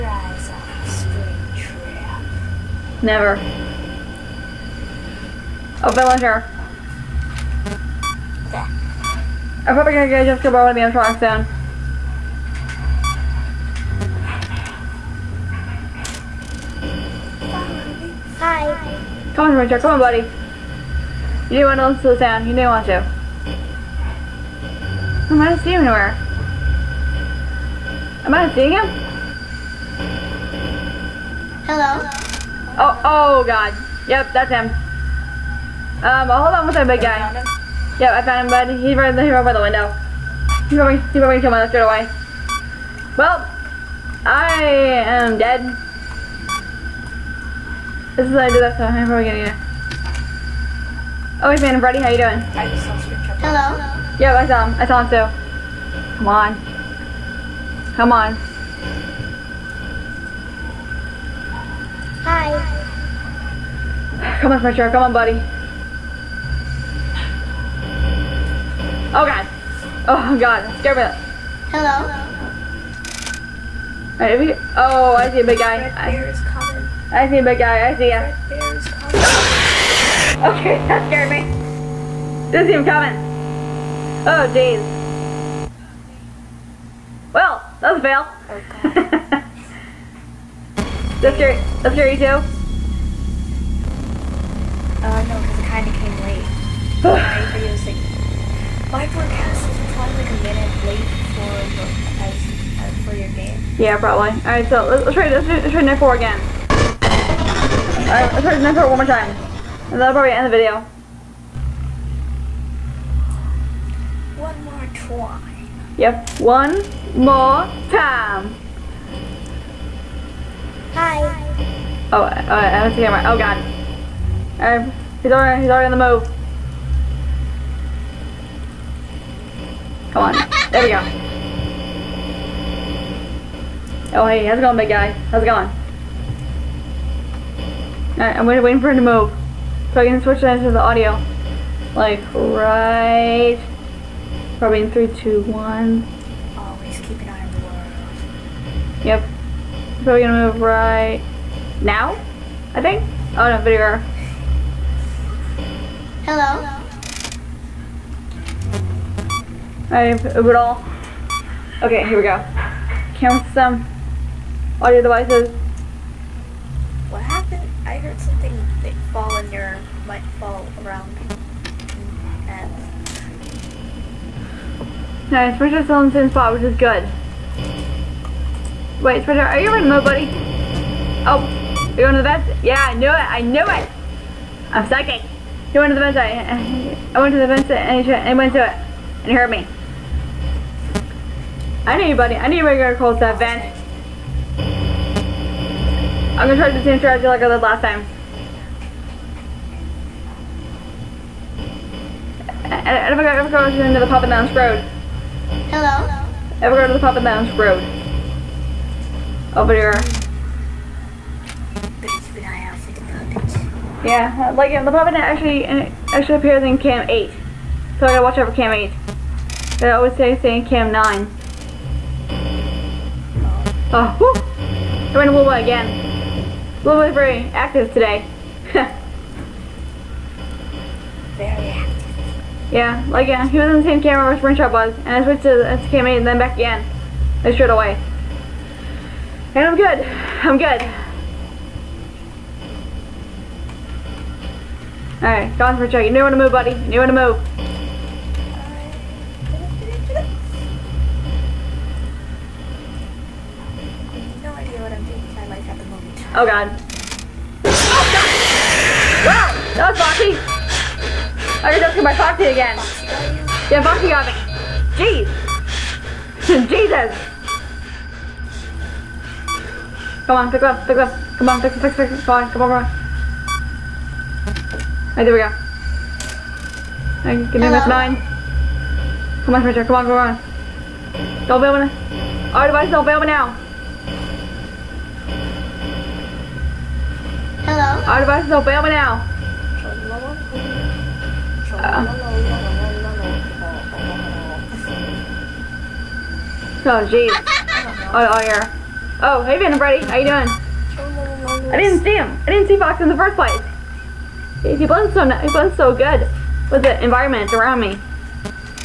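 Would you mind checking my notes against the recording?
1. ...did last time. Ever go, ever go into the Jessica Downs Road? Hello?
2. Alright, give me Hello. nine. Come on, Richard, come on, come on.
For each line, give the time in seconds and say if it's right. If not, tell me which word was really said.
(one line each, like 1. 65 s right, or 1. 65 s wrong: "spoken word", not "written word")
1. 197 s wrong: "Papa", not "Jessica"
2. 277 s right.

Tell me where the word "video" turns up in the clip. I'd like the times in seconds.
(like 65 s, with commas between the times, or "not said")
97 s, 110 s, 153 s.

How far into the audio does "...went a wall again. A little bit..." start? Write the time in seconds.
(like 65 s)
225 s.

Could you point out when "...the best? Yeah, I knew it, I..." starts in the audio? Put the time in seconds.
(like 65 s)
182 s.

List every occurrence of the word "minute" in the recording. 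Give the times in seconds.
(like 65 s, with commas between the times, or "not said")
100 s.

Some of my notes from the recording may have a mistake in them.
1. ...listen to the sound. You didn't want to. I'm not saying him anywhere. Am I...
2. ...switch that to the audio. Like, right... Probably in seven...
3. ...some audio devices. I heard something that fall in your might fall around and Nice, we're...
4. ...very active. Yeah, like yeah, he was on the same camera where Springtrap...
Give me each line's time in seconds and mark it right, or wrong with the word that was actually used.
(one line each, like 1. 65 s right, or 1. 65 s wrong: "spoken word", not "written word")
1. 21 s wrong: "seeing", not "saying"
2. 140 s wrong: "three", not "seven"
3. 163 s right
4. 231 s right.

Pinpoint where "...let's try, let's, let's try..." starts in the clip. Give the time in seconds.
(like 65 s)
105 s.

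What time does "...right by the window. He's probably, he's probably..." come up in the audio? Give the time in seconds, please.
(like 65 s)
39 s.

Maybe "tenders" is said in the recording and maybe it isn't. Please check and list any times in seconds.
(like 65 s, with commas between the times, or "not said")
not said.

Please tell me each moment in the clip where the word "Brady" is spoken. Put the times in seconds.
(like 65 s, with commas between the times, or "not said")
51 s, 299 s.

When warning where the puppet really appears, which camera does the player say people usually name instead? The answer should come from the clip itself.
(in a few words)
Cam 9.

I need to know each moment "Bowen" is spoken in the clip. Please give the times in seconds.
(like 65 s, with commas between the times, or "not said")
10 s.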